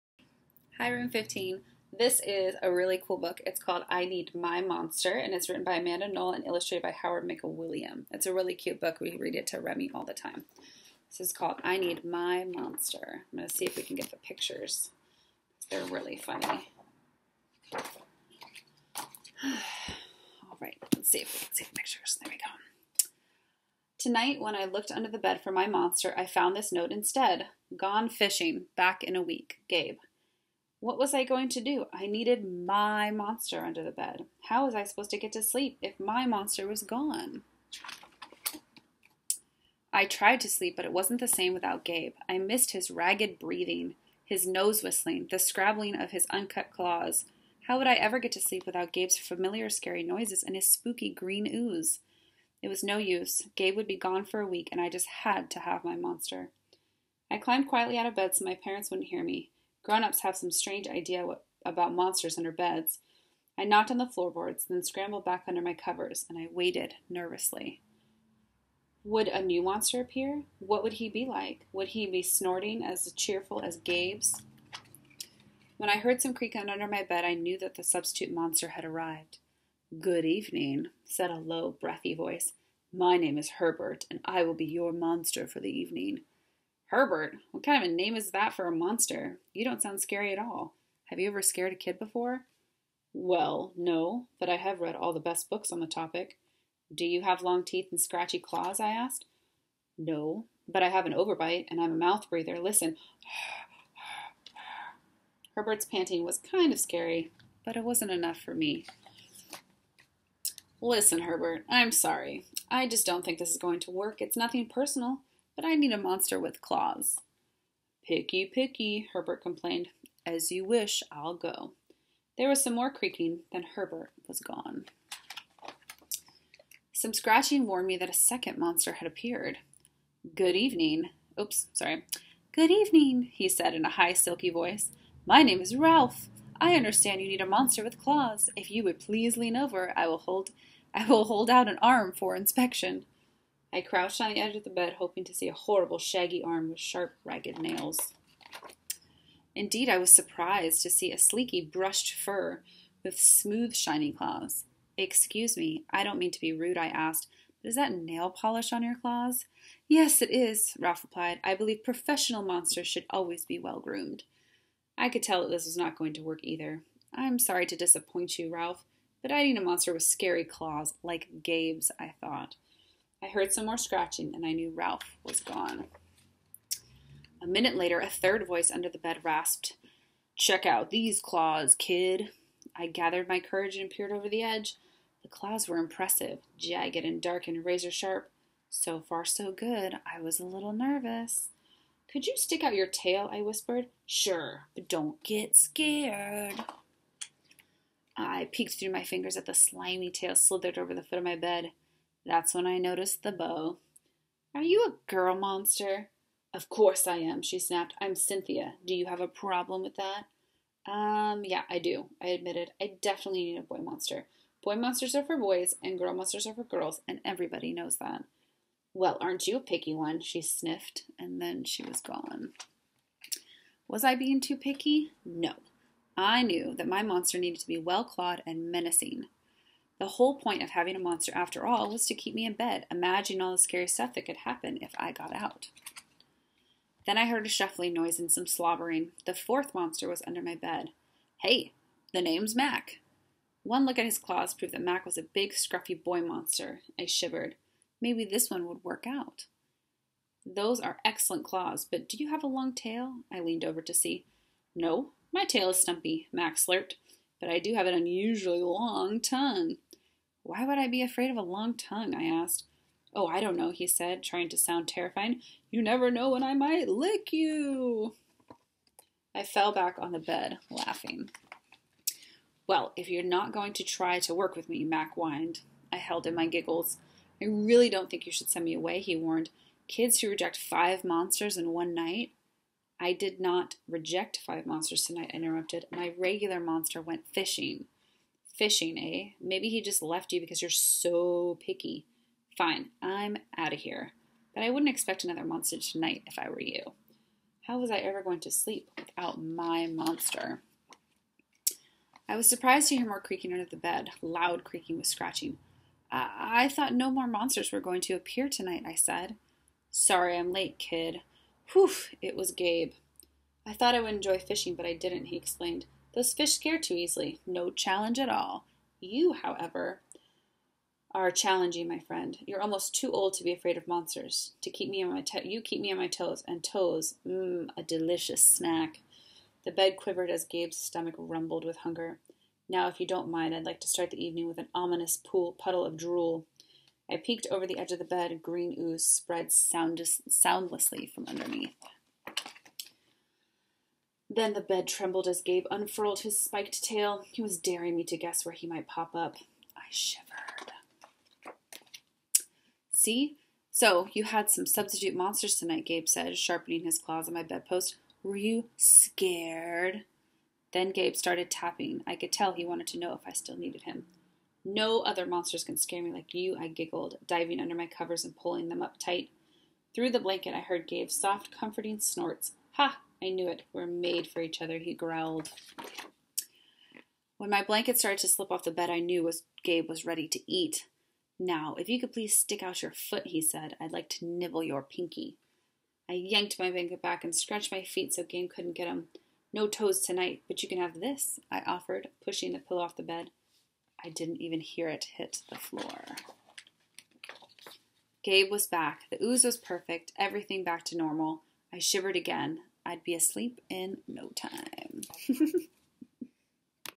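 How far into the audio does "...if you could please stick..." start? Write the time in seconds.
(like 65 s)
381 s.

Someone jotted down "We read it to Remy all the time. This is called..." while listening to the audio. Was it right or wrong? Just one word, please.
right.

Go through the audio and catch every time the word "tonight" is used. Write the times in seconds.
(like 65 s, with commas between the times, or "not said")
23 s, 285 s, 295 s, 308 s, 355 s, 390 s.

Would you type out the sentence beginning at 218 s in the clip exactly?
Well, aren't you a picky one?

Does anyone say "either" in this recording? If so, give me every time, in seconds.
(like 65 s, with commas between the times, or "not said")
166 s.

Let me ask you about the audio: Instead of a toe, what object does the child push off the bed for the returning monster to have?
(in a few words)
Pillow.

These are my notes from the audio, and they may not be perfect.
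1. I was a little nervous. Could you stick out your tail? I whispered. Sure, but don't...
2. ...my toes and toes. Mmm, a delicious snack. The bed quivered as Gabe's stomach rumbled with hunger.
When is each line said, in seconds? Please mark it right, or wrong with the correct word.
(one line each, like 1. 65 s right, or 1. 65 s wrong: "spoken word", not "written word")
1. 190 s right
2. 325 s right.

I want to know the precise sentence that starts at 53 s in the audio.
Gabe would be gone for a week, and I just had to have my monster.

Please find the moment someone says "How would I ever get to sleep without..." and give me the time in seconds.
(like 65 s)
47 s.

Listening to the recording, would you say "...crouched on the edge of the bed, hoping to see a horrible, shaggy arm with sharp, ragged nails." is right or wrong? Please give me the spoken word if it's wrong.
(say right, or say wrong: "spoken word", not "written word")
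right.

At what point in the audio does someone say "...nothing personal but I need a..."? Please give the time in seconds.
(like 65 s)
114 s.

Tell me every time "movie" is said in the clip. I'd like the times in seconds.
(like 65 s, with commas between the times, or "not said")
not said.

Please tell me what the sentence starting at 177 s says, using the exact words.
A minute later, a third voice under the bed rasped, Check out these claws, kid.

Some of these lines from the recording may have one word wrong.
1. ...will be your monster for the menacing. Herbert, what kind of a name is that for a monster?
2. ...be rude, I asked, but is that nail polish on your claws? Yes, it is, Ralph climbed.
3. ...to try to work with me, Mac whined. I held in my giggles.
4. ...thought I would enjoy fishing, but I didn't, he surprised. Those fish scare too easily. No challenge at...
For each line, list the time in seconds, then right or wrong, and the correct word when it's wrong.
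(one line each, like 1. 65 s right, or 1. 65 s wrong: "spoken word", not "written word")
1. 84 s wrong: "evening", not "menacing"
2. 156 s wrong: "replied", not "climbed"
3. 273 s right
4. 313 s wrong: "explained", not "surprised".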